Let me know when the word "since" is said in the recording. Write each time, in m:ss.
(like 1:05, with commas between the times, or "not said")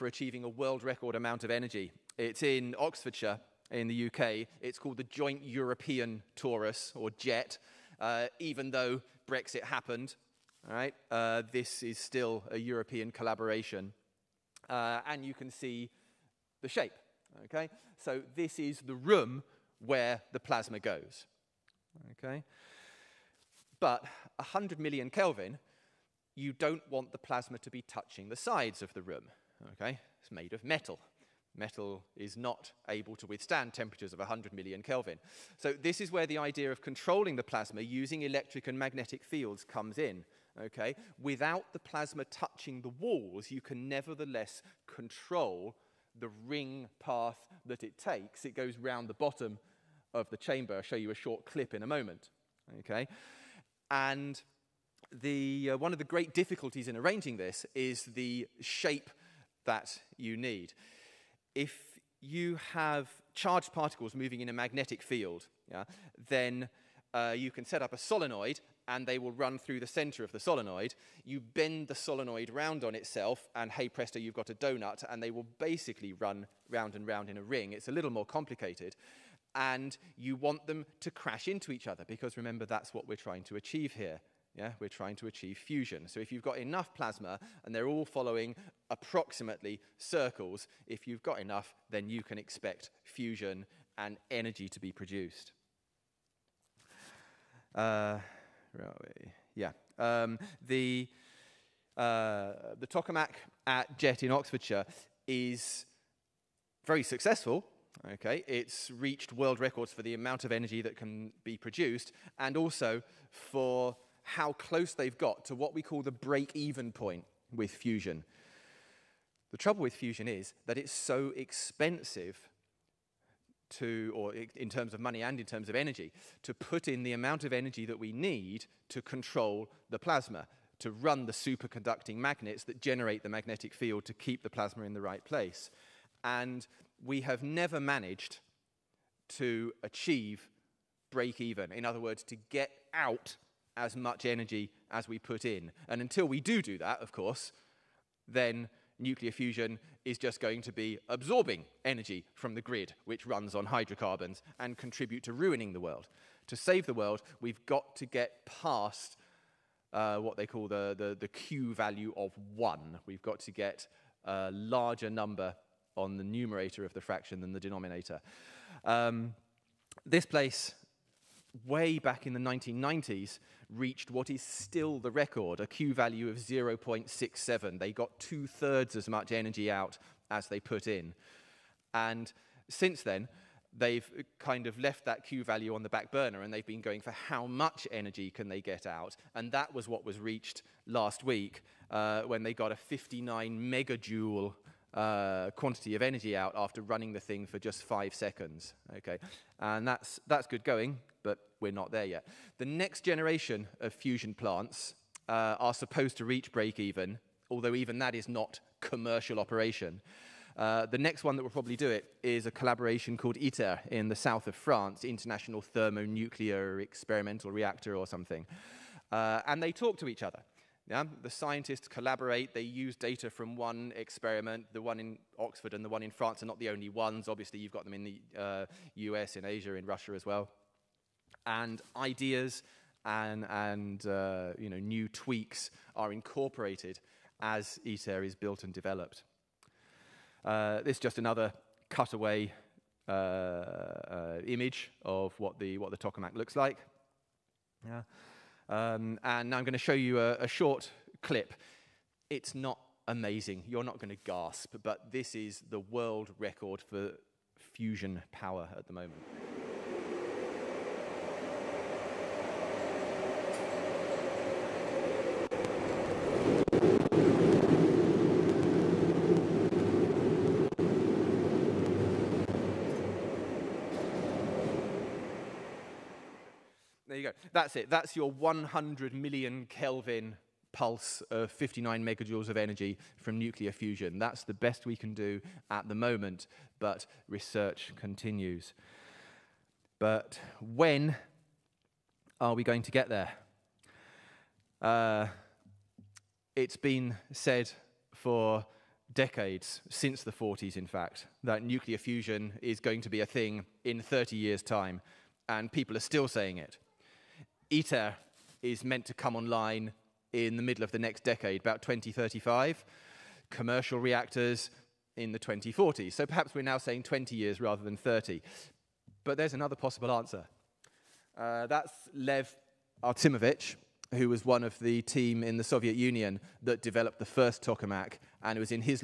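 3:02, 4:59.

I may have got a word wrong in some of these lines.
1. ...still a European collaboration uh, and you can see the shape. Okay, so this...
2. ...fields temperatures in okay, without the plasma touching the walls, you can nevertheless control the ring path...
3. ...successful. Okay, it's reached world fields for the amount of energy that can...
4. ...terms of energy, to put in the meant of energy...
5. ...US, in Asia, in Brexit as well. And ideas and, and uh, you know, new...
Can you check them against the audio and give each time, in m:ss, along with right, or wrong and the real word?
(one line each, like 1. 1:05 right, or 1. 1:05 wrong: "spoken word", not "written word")
1. 0:11 right
2. 0:39 wrong: "comes", not "temperatures"
3. 1:47 wrong: "records", not "fields"
4. 2:05 wrong: "amount", not "meant"
5. 3:48 wrong: "Russia", not "Brexit".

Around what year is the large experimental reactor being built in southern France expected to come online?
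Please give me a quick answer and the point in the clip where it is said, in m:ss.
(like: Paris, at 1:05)
2035, at 5:11.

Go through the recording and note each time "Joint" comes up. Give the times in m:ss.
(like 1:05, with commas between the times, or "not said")
0:05.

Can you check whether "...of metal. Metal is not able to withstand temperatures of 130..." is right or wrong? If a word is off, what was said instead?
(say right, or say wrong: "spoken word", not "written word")
wrong: "100", not "130".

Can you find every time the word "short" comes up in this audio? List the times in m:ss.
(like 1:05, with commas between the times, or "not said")
0:51, 4:10.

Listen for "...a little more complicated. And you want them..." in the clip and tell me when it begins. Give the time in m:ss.
1:17.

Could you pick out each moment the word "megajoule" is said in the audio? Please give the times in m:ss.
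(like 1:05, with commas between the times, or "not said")
3:13, 4:42.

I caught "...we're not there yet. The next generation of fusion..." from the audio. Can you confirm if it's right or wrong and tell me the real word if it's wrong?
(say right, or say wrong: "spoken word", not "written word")
right.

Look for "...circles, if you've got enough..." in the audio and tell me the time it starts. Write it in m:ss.
1:29.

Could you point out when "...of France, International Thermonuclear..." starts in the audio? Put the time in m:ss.
3:34.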